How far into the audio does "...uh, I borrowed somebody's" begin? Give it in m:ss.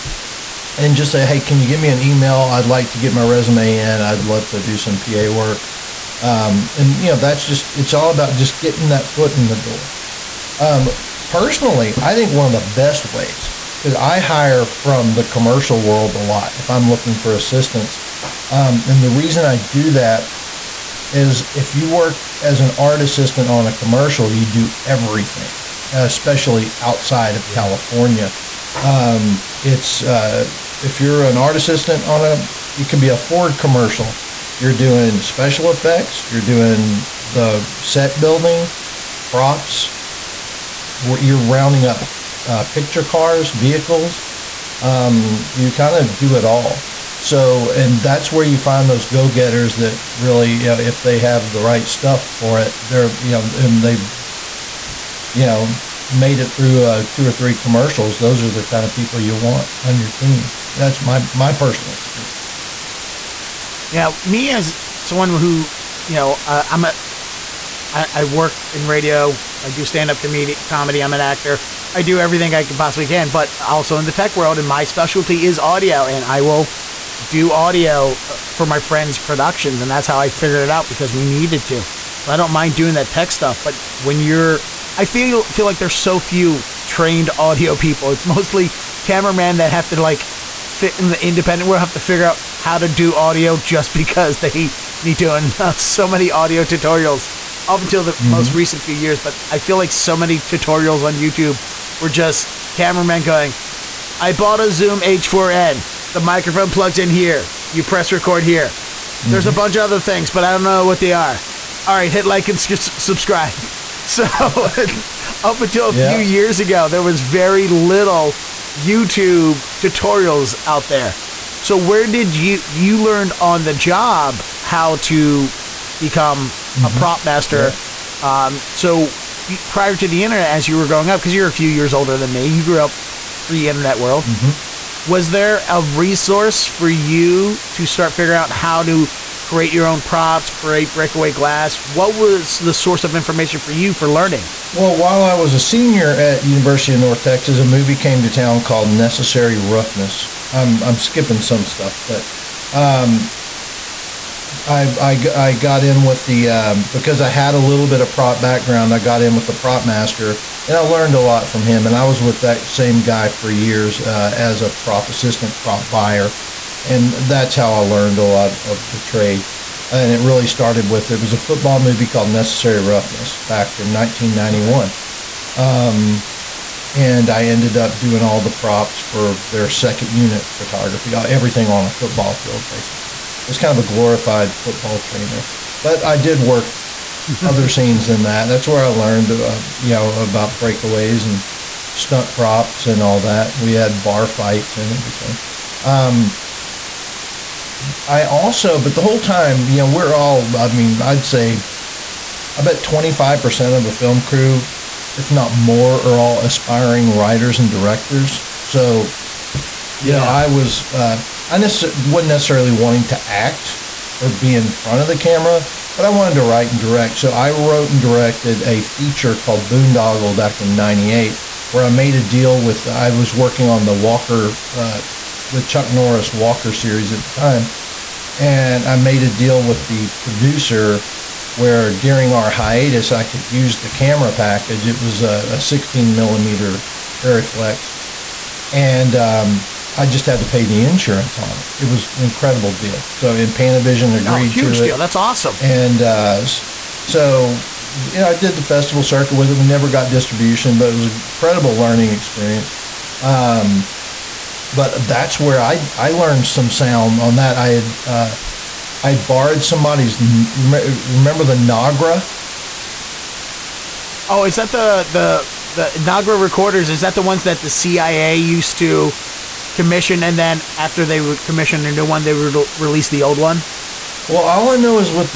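4:18.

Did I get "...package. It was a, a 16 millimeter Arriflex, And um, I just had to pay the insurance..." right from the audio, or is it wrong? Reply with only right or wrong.
right.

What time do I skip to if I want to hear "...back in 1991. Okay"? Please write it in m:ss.
2:53.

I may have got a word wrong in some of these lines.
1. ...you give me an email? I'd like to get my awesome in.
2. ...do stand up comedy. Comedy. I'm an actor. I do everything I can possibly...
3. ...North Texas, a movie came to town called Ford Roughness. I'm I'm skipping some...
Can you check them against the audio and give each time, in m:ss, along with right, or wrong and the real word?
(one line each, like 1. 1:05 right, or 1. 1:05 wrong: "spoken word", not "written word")
1. 0:01 wrong: "resume", not "awesome"
2. 1:09 right
3. 2:27 wrong: "Necessary", not "Ford".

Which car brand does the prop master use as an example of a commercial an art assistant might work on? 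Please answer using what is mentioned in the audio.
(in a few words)
Ford.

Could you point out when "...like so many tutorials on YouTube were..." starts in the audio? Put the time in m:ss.
1:39.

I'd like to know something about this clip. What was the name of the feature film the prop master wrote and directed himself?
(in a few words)
Boondoggle.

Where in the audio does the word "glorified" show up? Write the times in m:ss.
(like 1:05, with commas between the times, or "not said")
3:03.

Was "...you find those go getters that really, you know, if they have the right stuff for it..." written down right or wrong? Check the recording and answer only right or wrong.
right.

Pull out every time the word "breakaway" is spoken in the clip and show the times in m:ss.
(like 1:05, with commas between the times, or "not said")
2:20, 3:10.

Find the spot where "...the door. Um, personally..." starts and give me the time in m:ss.
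0:09.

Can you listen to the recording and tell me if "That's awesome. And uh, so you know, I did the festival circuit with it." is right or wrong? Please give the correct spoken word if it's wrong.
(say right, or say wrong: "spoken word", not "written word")
right.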